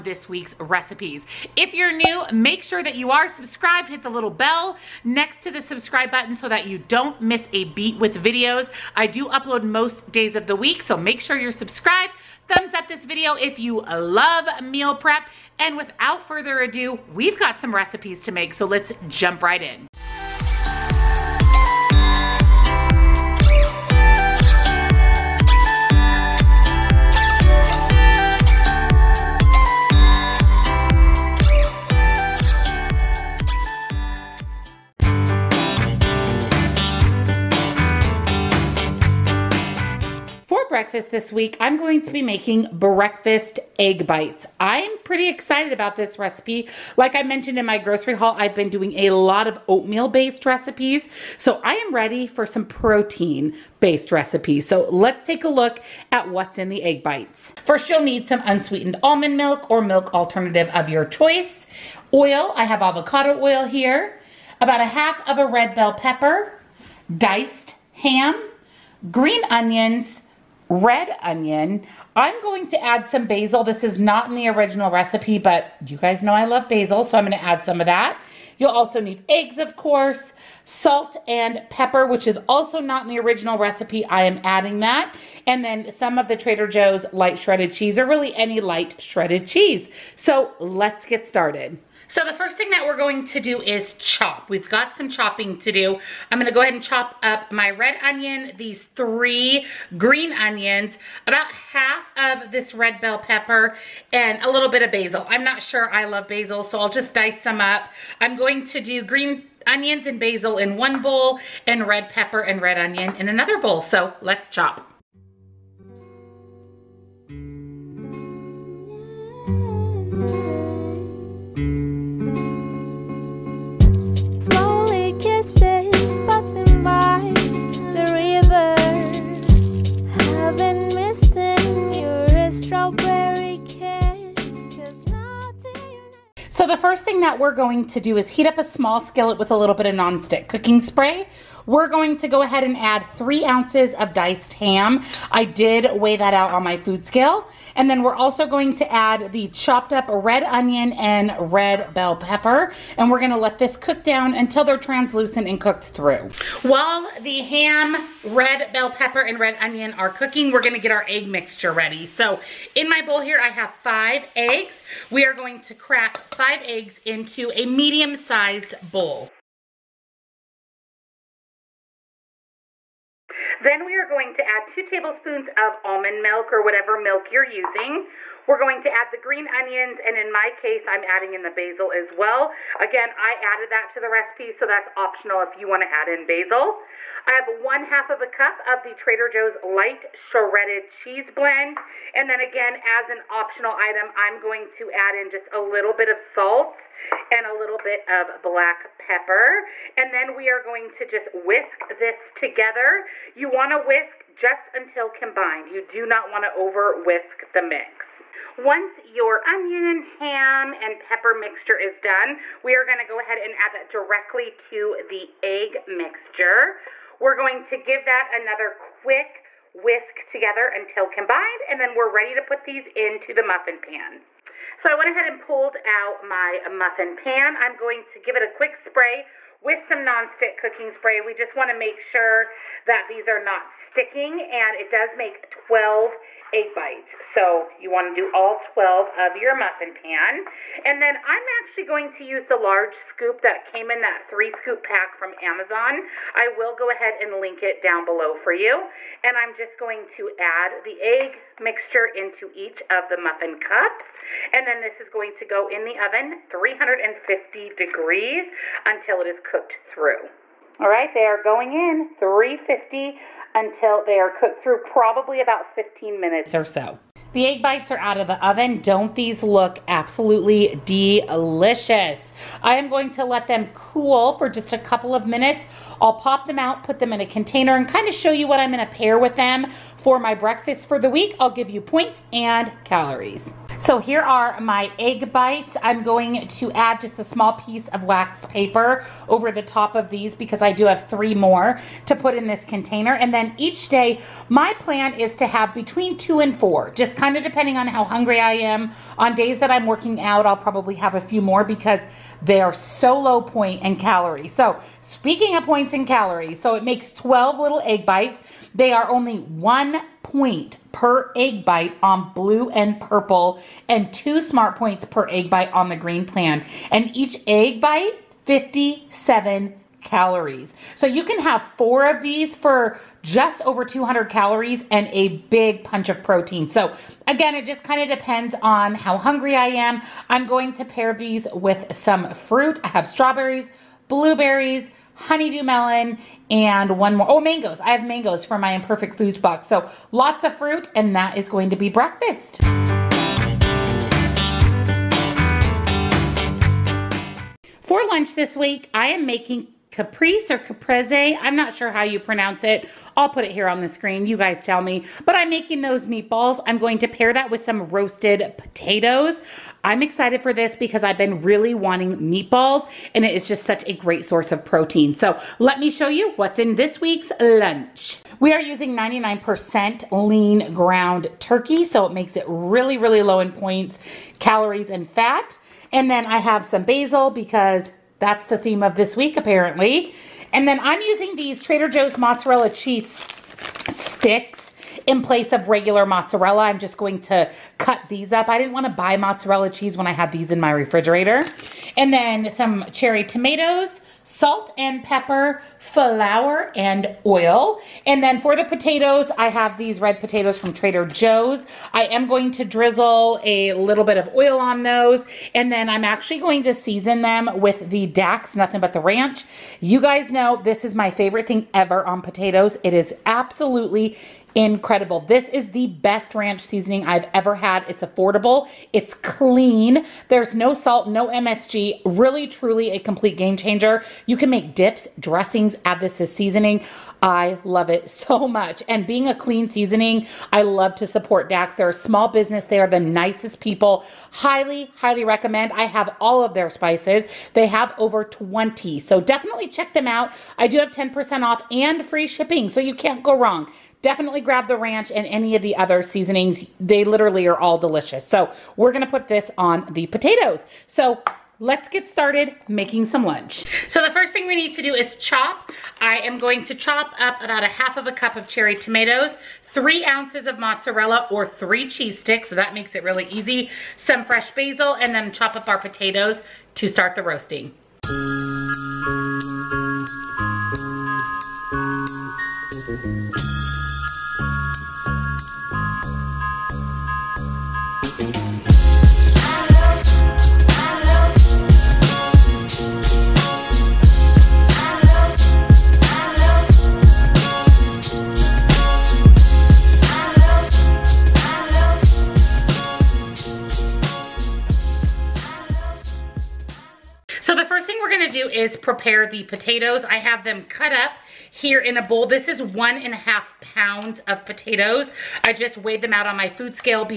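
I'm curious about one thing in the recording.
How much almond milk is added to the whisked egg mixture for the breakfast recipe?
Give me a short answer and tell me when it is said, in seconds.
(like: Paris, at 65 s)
2 tablespoons, at 174 s.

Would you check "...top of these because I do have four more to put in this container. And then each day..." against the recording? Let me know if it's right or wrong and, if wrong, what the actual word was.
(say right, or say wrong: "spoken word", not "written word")
wrong: "three", not "four".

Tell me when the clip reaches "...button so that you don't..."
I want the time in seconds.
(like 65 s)
6 s.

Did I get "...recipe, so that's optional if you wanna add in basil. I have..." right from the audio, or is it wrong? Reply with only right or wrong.
right.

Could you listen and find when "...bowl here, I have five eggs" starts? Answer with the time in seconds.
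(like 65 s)
163 s.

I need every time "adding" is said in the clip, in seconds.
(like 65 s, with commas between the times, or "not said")
84 s, 181 s.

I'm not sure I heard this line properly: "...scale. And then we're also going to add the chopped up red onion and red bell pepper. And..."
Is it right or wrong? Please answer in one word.
right.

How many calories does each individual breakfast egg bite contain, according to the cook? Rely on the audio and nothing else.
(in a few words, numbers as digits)
57.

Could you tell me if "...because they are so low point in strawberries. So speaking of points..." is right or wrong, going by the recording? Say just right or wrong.
wrong.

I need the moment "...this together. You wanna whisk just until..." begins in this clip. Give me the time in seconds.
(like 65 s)
201 s.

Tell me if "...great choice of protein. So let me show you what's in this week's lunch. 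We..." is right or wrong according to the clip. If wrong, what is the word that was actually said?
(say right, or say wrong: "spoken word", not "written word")
wrong: "source", not "choice".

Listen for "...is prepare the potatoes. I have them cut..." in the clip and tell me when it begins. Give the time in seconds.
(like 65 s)
498 s.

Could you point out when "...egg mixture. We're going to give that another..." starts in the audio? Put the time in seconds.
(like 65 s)
215 s.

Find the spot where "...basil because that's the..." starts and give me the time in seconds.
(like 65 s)
376 s.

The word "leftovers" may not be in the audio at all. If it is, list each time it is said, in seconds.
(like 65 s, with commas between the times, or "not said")
not said.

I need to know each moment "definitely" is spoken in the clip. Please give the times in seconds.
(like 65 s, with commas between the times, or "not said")
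439 s, 444 s.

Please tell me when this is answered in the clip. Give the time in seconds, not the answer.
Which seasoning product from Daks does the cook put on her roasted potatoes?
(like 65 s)
408 s.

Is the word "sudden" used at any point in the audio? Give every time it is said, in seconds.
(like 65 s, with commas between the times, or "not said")
not said.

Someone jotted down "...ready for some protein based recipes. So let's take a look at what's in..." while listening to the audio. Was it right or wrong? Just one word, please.
right.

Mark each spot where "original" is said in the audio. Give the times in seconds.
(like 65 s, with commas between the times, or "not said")
74 s, 83 s.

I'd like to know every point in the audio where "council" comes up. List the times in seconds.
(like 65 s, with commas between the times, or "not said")
not said.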